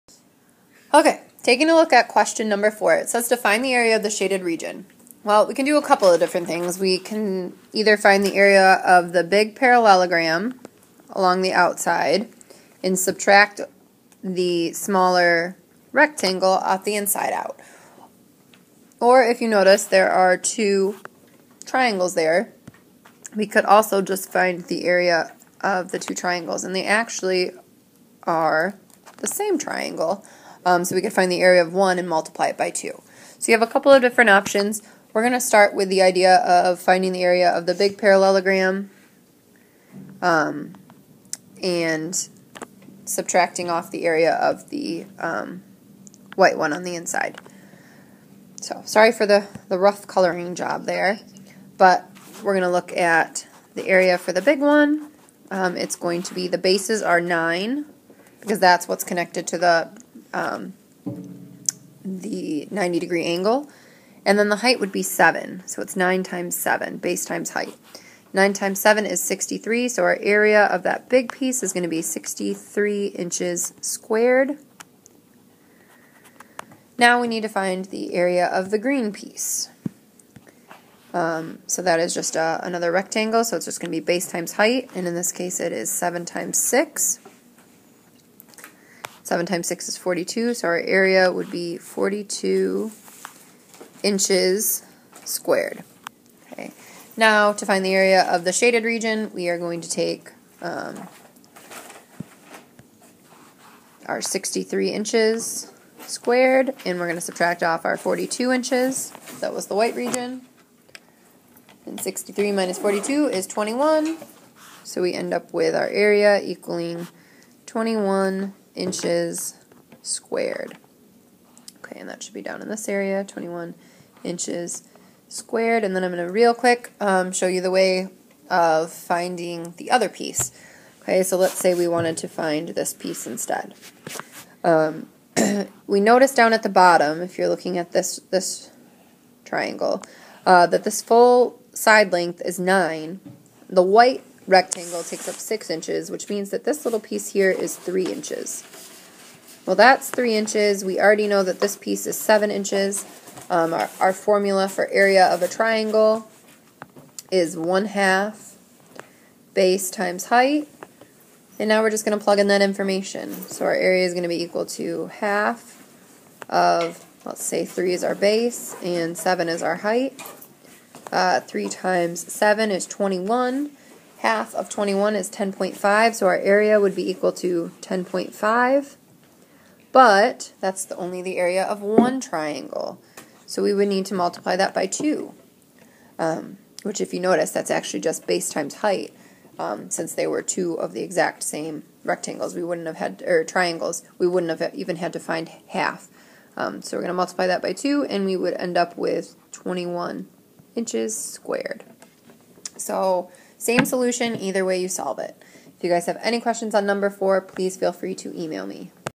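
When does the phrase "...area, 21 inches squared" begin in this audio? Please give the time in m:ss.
2:02.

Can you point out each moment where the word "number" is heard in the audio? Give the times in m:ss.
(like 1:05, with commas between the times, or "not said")
0:02, 3:26.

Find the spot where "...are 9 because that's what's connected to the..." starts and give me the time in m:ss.
0:57.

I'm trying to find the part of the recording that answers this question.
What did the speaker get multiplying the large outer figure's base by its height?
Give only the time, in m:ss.
1:08.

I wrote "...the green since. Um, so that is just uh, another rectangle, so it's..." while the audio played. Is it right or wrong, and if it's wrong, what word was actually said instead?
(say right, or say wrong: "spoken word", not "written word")
wrong: "piece", not "since".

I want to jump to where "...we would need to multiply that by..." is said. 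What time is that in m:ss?
3:03.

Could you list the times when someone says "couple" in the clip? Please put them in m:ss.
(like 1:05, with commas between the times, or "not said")
0:05, 0:33.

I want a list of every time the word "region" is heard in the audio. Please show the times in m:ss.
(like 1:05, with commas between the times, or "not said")
0:04, 1:38, 1:49.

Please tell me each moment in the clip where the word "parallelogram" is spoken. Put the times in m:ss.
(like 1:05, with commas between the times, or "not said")
0:09, 0:37.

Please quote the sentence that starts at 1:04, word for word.
And then the height would be 7.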